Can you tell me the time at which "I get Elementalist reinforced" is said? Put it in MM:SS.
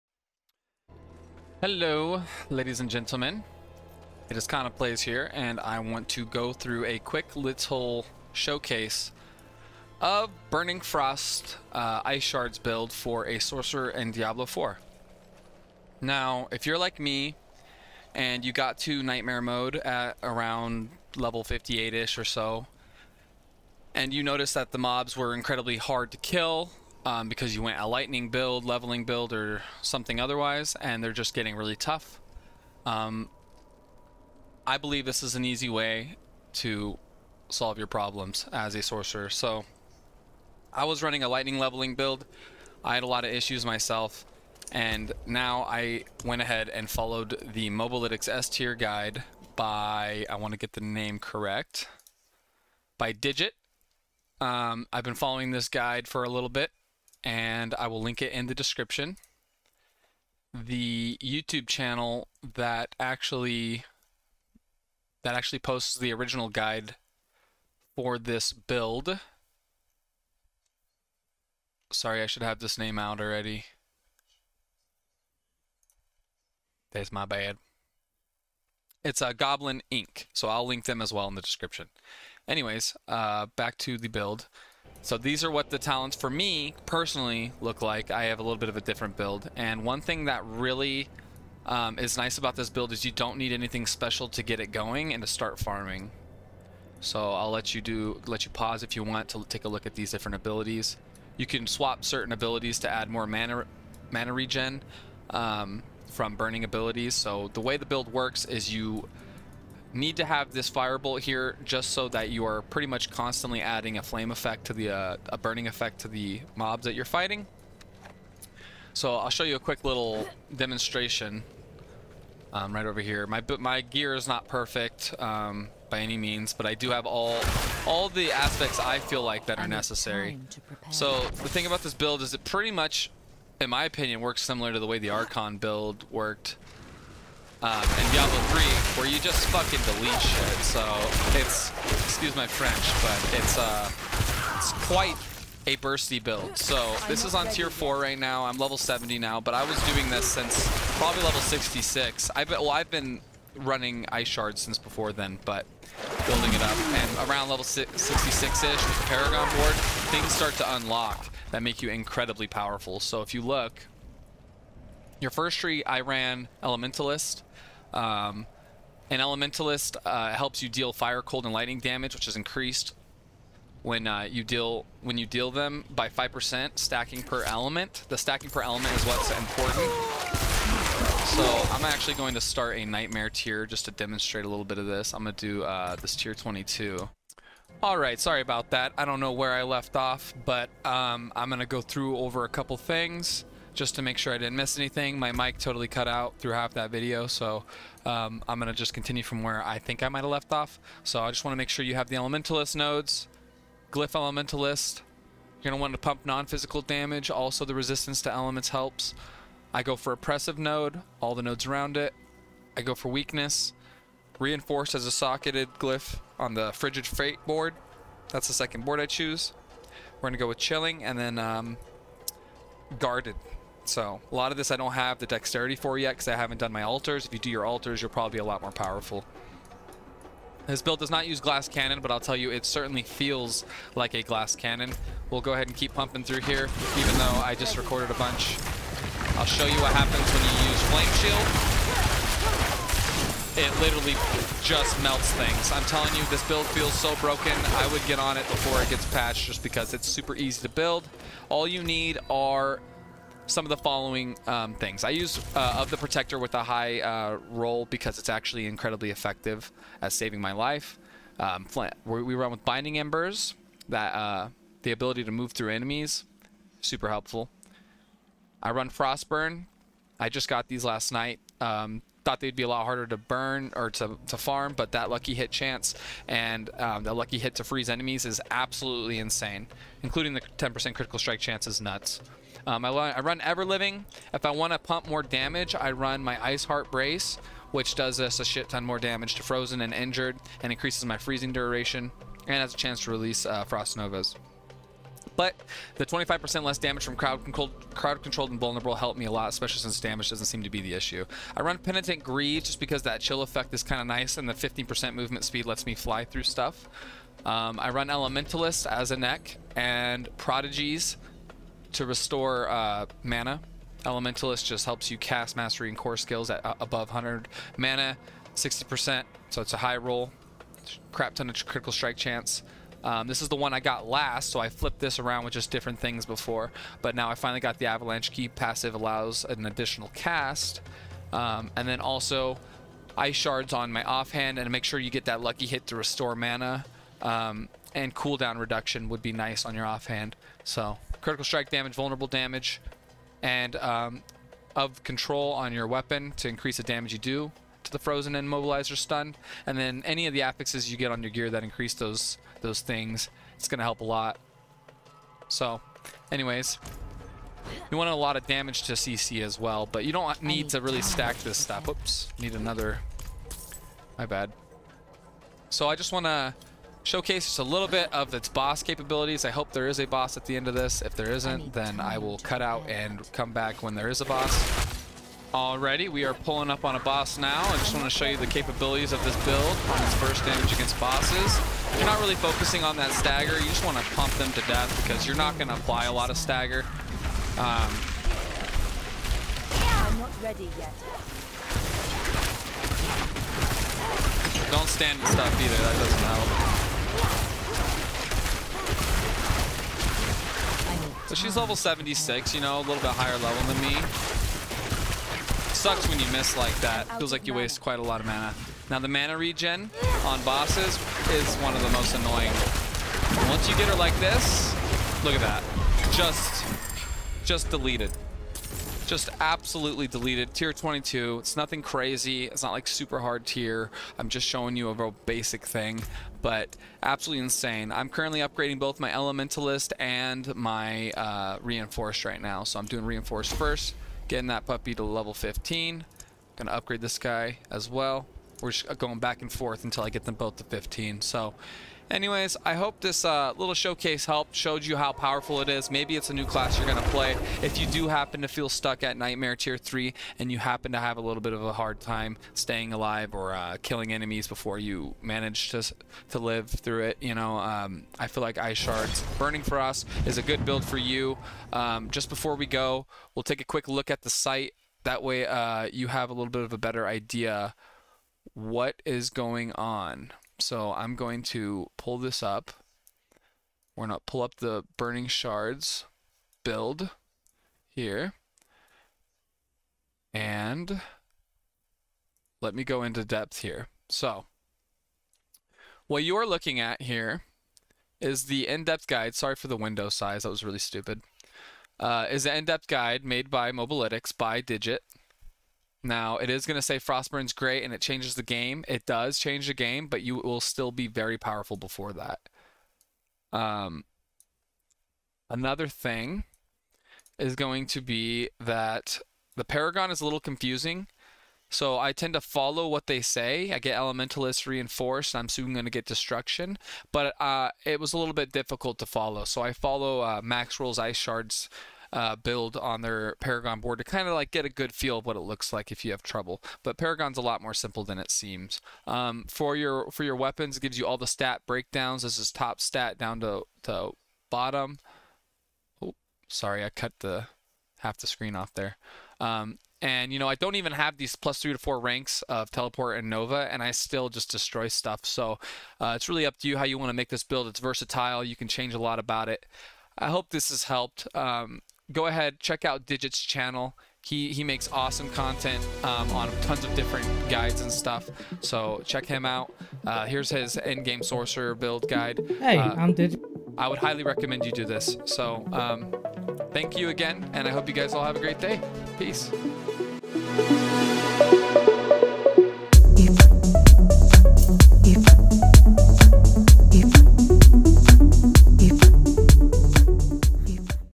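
08:33.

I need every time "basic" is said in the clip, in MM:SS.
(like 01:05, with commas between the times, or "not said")
07:05.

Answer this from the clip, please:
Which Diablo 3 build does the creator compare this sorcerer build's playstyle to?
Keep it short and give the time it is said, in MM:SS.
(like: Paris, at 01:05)
Archon, at 02:15.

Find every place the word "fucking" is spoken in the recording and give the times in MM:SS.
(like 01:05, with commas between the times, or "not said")
02:19.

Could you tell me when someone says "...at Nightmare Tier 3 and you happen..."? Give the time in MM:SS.
07:29.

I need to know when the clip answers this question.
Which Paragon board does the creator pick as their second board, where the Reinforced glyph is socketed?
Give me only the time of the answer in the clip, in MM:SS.
03:36.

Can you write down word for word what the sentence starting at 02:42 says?
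So if you look, your first tree, I ran Elementalist.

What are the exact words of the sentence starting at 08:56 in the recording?
Oh, sorry, I cut the half the screen off there.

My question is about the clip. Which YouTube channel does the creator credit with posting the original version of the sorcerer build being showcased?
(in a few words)
Goblin Inc.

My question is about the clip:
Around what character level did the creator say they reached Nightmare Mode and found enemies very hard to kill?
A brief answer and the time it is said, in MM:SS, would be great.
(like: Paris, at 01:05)
58, at 00:21.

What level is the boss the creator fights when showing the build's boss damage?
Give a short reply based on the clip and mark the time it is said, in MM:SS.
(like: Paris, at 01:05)
76, at 06:41.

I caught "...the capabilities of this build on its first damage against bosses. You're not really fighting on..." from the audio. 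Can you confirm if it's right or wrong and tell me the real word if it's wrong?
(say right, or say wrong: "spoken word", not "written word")
wrong: "focusing", not "fighting".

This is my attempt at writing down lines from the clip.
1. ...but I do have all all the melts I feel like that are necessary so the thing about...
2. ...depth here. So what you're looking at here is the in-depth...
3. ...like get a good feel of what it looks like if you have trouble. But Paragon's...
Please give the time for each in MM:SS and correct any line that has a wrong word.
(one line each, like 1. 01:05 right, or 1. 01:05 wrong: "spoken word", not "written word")
1. 02:06 wrong: "aspects", not "melts"
2. 08:03 right
3. 08:44 right.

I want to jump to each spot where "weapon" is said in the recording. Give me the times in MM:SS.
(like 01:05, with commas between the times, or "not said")
05:45, 08:50.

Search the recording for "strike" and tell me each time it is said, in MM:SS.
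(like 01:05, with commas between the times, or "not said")
04:41, 05:21, 05:41.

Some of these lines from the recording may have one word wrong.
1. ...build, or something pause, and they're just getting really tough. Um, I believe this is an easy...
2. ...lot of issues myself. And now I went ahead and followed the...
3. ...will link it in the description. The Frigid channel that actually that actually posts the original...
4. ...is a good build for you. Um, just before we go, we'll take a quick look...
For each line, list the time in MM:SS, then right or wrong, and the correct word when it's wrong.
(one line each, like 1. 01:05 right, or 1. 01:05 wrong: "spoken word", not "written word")
1. 00:29 wrong: "otherwise", not "pause"
2. 00:43 right
3. 00:57 wrong: "YouTube", not "Frigid"
4. 07:40 right.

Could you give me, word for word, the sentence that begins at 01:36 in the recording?
So I'll let you do, let you pause if you want to take a look at these different abilities.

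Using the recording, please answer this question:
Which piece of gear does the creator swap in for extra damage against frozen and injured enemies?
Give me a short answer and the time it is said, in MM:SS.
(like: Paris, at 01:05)
Iceheart Brace, at 04:46.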